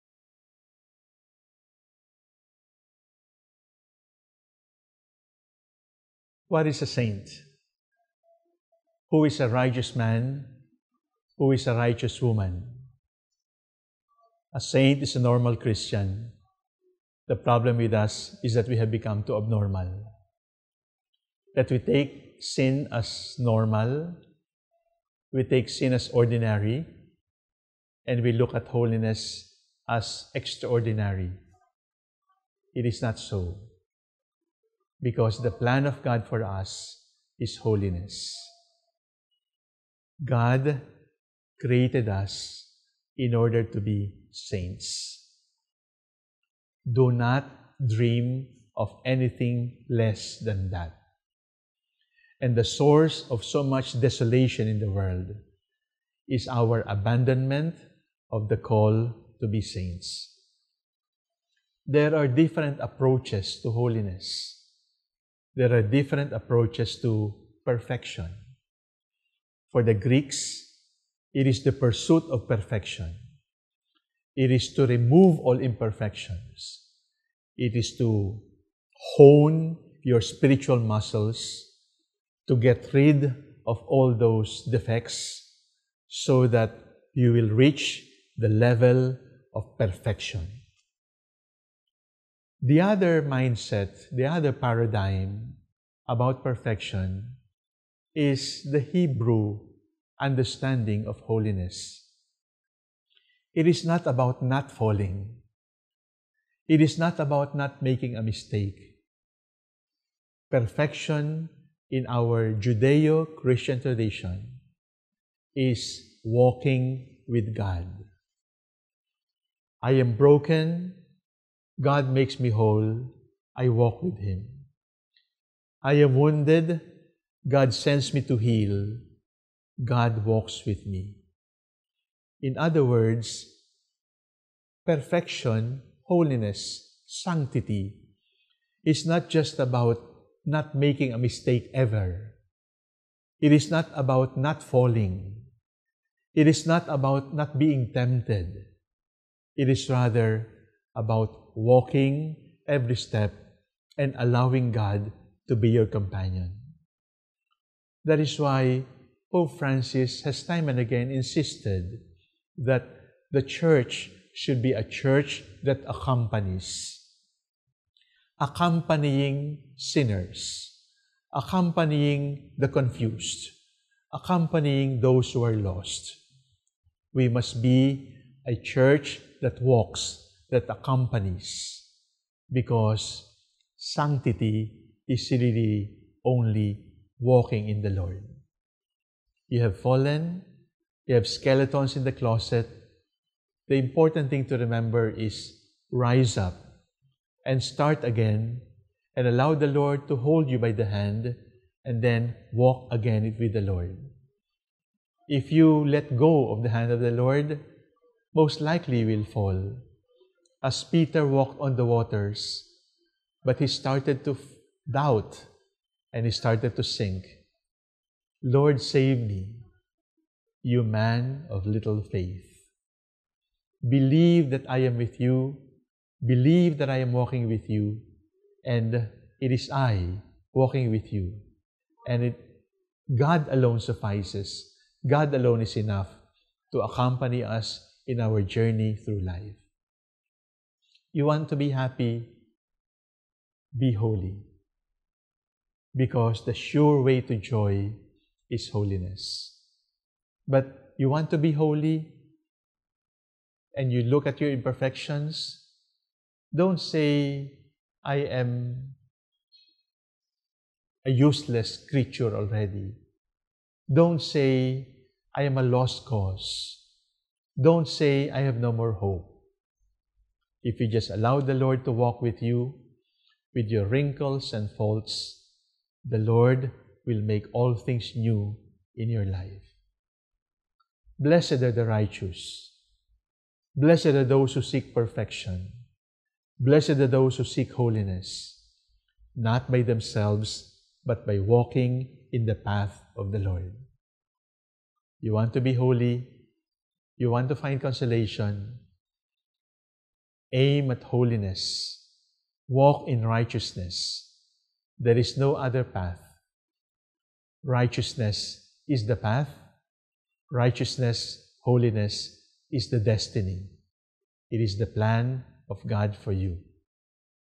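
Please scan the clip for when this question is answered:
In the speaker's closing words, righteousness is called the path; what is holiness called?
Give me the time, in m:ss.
5:12.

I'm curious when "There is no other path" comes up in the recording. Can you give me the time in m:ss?
5:04.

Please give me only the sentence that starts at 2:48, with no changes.
Accompanying sinners, accompanying the confused, accompanying those who are lost.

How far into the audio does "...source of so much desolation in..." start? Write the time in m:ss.
0:52.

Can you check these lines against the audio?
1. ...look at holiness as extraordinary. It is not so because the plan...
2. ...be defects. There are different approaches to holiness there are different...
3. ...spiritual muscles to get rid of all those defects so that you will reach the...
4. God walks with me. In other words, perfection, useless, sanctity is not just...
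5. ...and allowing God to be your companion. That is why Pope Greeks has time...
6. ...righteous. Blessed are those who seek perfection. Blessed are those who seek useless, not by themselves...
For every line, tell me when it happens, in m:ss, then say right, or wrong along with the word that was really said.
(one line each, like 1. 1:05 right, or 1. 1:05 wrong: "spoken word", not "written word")
1. 0:28 right
2. 0:59 wrong: "saints", not "defects"
3. 1:20 right
4. 2:09 wrong: "holiness", not "useless"
5. 2:33 wrong: "Francis", not "Greeks"
6. 4:41 wrong: "holiness", not "useless".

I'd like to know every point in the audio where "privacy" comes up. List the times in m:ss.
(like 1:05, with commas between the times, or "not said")
not said.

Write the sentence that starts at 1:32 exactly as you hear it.
The other mindset, the other paradigm about perfection is the Hebrew understanding of holiness.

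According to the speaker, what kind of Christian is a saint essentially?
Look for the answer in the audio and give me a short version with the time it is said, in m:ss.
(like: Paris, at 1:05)
A normal Christian, at 0:15.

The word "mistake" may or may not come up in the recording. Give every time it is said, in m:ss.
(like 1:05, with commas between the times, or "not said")
1:48, 2:21.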